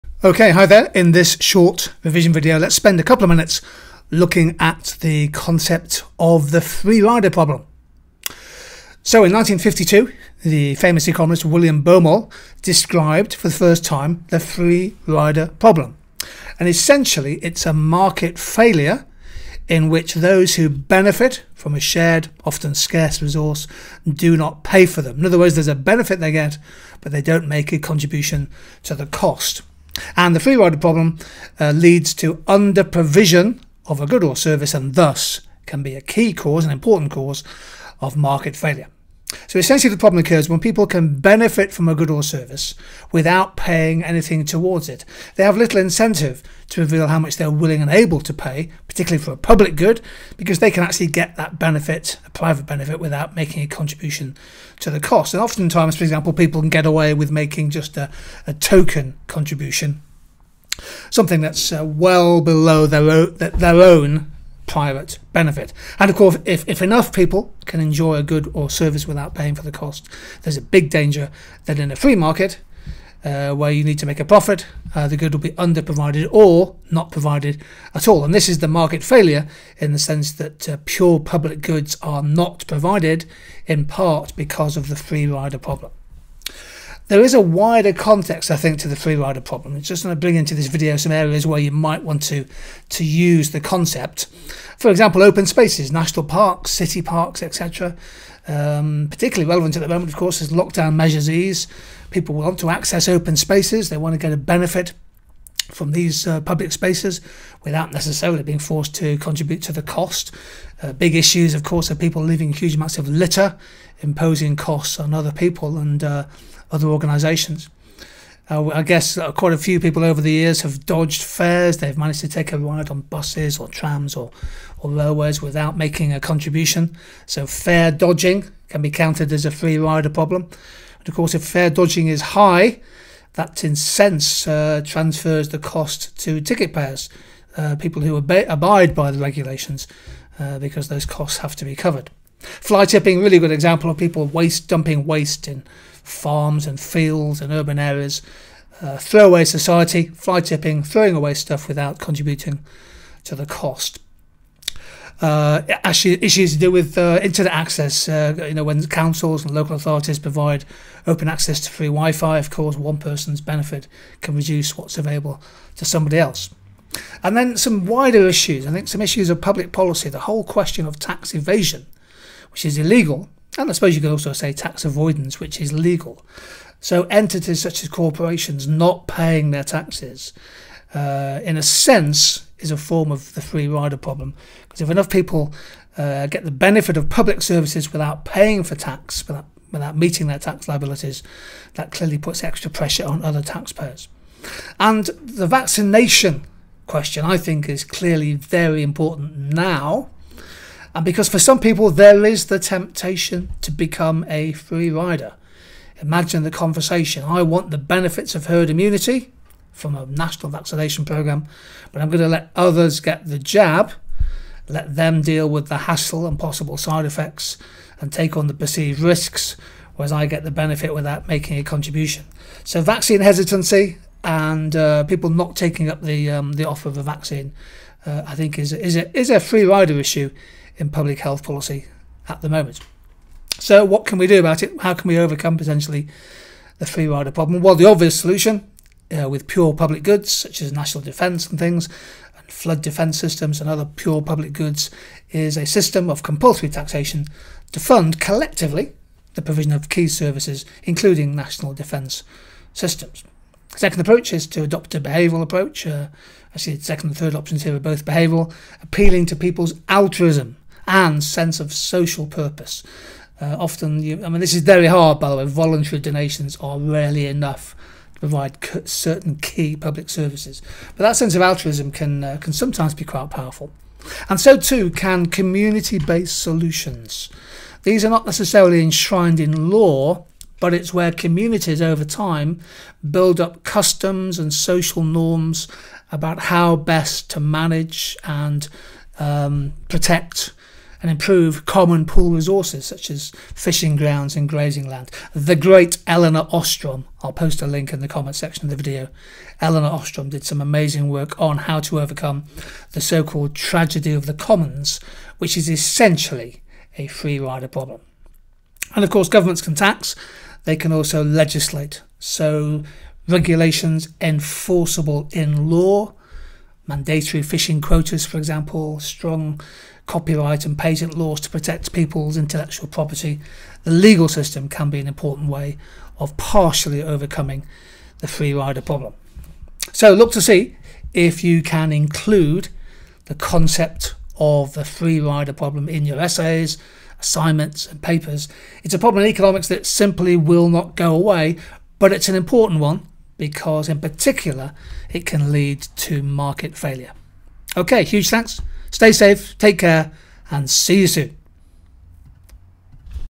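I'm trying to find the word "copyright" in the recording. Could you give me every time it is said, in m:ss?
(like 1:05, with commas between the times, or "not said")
5:20.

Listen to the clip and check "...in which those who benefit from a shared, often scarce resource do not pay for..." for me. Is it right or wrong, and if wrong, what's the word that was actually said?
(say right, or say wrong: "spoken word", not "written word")
right.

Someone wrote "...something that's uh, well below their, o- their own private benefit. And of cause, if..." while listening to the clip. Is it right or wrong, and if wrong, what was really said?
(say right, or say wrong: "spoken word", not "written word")
wrong: "course", not "cause".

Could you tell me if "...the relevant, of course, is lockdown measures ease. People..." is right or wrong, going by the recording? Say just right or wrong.
wrong.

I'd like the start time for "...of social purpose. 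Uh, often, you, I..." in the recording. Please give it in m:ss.
4:21.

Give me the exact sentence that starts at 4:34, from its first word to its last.
And so too can community based solutions.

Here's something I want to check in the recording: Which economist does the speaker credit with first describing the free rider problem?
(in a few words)
William Baumol.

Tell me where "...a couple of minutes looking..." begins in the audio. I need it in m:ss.
0:02.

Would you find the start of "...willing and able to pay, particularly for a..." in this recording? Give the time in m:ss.
0:47.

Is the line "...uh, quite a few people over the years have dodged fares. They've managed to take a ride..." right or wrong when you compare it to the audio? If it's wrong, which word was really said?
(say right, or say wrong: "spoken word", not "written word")
right.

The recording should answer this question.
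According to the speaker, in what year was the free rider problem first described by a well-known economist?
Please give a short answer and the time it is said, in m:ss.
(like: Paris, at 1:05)
1952, at 0:09.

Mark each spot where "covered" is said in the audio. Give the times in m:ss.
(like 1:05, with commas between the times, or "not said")
2:21.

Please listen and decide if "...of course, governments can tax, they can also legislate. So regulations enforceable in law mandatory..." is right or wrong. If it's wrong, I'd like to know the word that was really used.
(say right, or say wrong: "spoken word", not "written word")
right.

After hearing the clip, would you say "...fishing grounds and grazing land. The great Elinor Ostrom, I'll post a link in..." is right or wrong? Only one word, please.
right.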